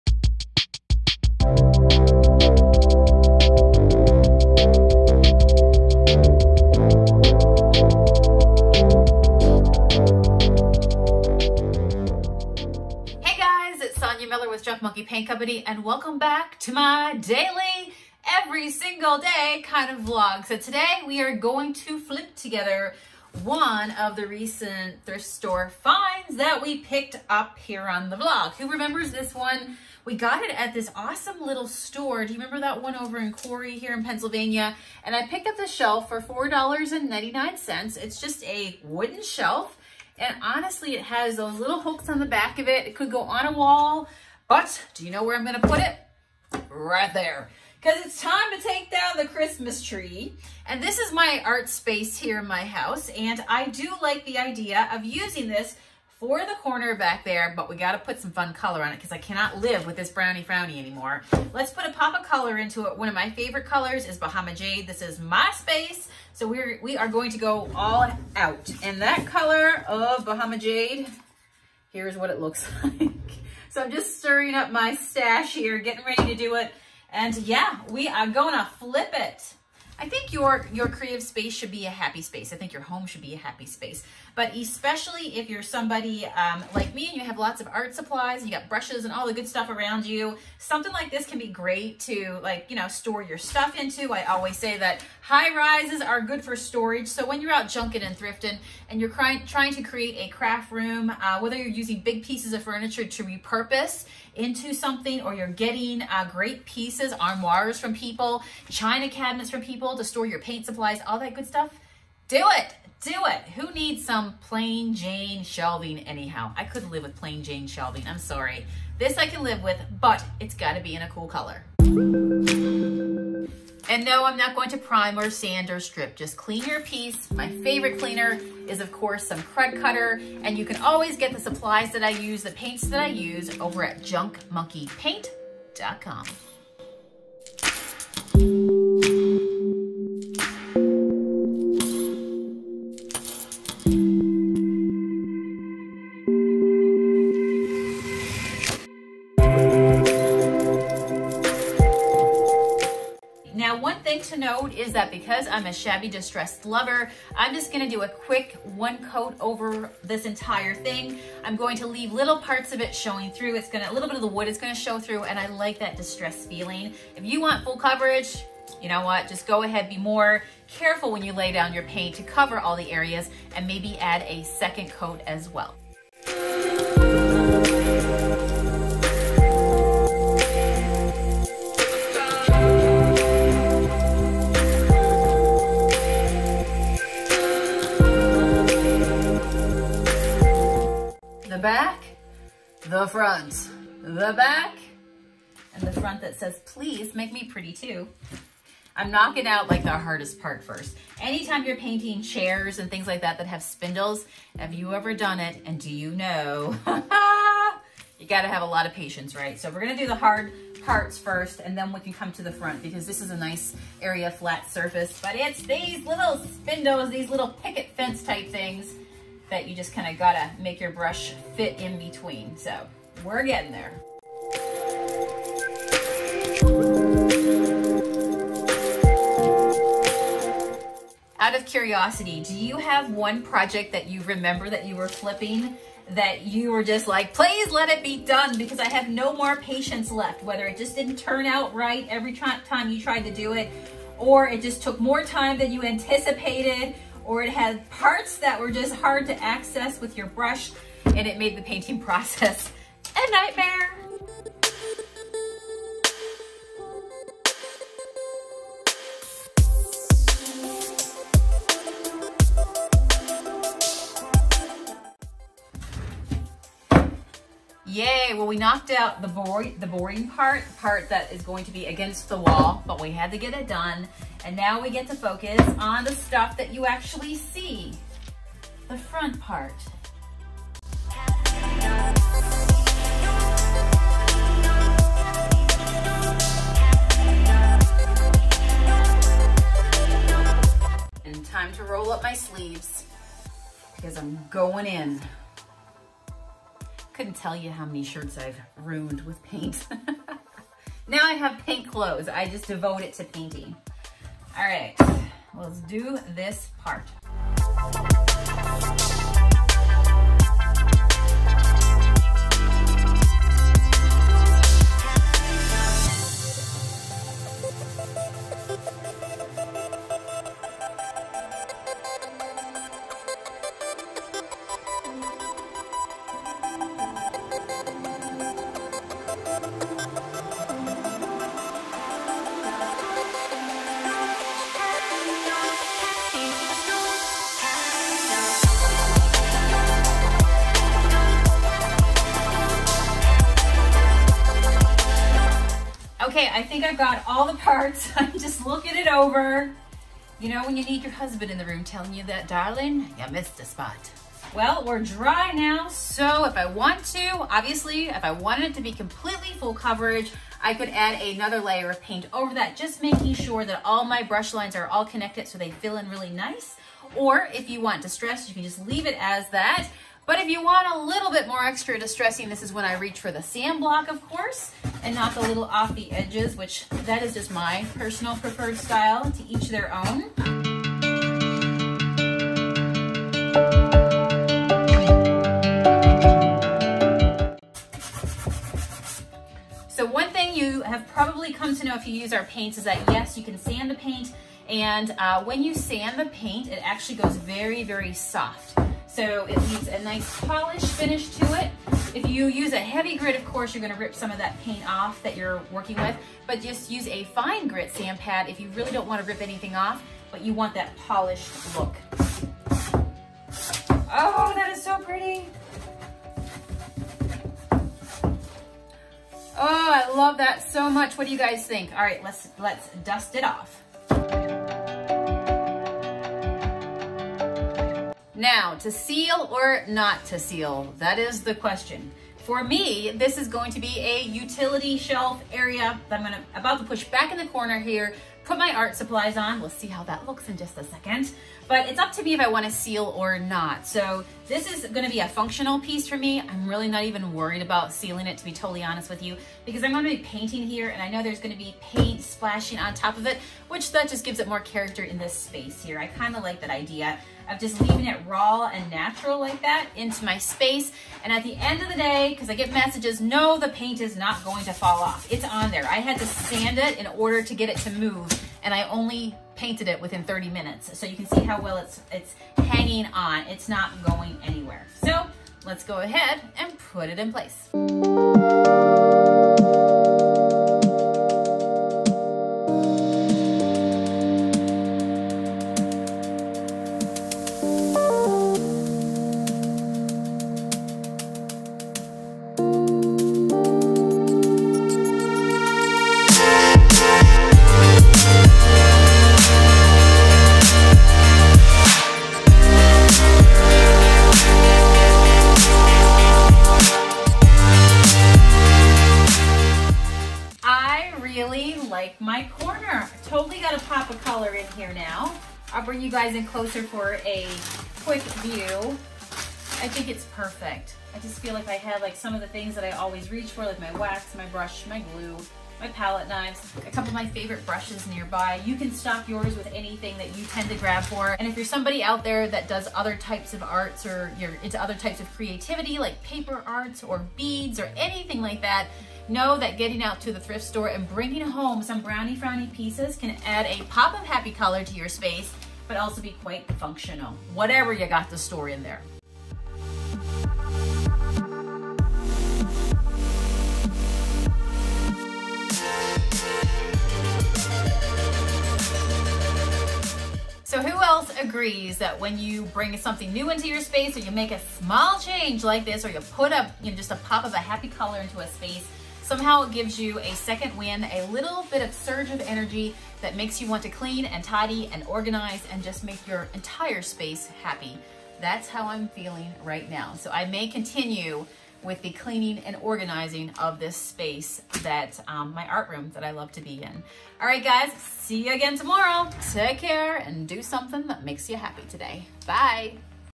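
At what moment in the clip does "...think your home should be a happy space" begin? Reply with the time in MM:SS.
01:22.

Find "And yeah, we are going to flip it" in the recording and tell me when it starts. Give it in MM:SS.
01:17.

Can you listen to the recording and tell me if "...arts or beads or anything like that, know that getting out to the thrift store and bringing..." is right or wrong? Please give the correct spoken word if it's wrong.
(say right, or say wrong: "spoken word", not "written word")
right.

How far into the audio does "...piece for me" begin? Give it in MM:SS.
07:25.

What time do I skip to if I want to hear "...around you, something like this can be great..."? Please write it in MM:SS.
01:29.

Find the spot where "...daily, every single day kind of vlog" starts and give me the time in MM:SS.
00:17.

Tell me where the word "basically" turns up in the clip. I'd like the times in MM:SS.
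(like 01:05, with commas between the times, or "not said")
not said.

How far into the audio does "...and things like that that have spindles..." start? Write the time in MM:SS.
03:22.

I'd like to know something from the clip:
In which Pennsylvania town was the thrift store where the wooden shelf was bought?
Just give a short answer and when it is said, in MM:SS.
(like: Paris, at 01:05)
Corry, at 00:33.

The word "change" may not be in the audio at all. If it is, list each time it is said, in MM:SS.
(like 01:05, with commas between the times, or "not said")
09:25.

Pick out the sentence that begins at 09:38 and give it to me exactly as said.
That's how I'm feeling right now.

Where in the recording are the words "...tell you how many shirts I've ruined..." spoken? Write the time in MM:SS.
04:57.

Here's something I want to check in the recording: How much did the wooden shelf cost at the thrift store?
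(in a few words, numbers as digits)
$4.99.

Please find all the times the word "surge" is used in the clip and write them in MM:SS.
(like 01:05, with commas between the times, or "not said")
09:31.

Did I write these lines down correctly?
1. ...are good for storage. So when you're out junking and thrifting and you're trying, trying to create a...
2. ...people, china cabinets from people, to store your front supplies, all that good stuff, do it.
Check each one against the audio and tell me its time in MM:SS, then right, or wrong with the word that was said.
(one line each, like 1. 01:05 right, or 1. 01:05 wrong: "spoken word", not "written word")
1. 01:36 right
2. 01:47 wrong: "paint", not "front".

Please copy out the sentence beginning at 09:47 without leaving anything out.
All right, guys, see you again tomorrow.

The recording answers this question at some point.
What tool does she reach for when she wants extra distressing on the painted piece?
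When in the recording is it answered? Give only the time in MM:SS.
06:13.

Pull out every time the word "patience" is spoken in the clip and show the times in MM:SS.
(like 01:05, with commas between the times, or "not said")
03:28, 03:59.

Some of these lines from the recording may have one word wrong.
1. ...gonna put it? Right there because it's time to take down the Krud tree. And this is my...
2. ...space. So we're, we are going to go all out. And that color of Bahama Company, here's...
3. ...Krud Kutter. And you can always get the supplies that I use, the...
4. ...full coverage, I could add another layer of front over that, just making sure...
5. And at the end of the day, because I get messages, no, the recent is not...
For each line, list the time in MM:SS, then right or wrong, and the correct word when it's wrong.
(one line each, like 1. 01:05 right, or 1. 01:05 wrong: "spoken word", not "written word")
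1. 00:45 wrong: "Christmas", not "Krud"
2. 01:05 wrong: "Jade", not "Company"
3. 02:09 right
4. 05:59 wrong: "paint", not "front"
5. 07:41 wrong: "paint", not "recent".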